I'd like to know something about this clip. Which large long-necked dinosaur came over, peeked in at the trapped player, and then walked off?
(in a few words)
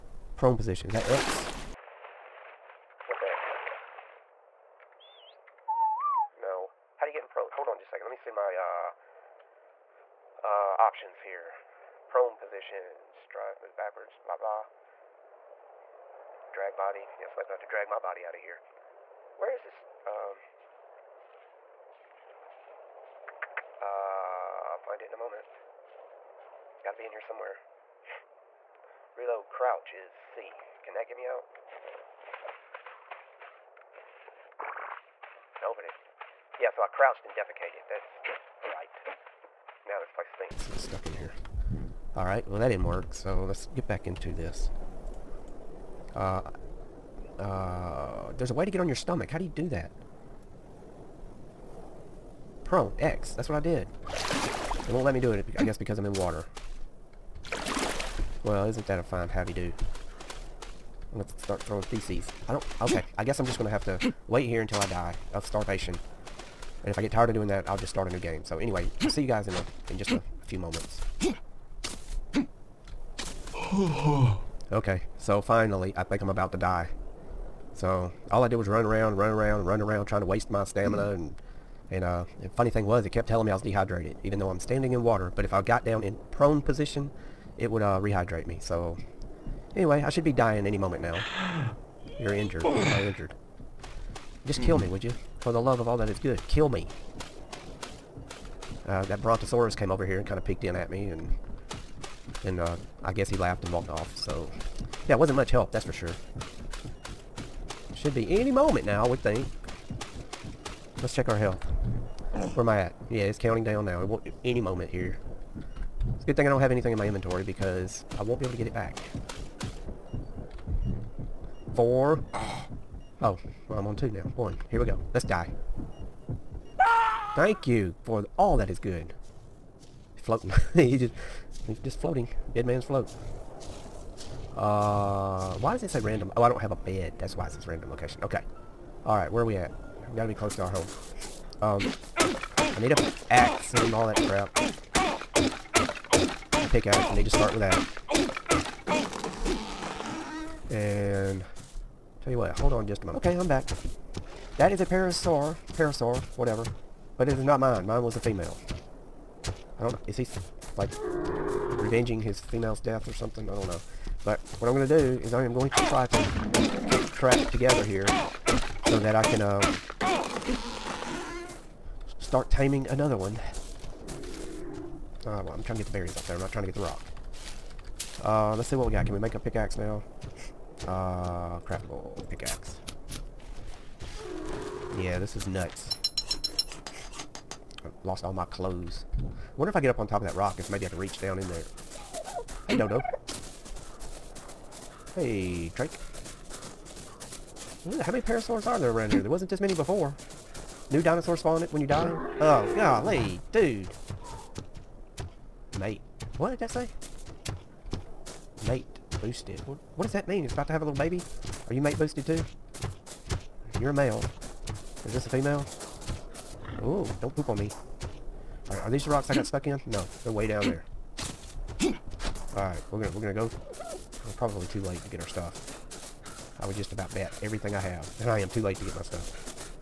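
Brontosaurus.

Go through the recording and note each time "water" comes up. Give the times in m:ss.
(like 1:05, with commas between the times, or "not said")
0:56, 1:25.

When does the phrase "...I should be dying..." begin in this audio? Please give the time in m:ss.
1:30.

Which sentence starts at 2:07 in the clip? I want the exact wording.
Thank you for all that is good.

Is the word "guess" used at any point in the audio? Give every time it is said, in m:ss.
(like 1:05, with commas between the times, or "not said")
0:55, 1:03, 1:43.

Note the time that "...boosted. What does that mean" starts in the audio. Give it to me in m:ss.
3:29.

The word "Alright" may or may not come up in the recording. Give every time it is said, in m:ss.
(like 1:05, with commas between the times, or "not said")
0:42, 2:19, 3:41.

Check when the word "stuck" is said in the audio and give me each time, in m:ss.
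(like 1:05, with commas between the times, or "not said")
0:40, 3:39.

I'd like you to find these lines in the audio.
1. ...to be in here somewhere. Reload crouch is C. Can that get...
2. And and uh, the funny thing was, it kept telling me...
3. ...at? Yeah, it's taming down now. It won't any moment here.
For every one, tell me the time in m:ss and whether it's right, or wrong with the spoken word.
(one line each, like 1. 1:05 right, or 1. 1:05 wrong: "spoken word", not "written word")
1. 0:26 right
2. 1:21 right
3. 1:52 wrong: "counting", not "taming".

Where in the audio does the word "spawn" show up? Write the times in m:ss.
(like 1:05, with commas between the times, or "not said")
3:21.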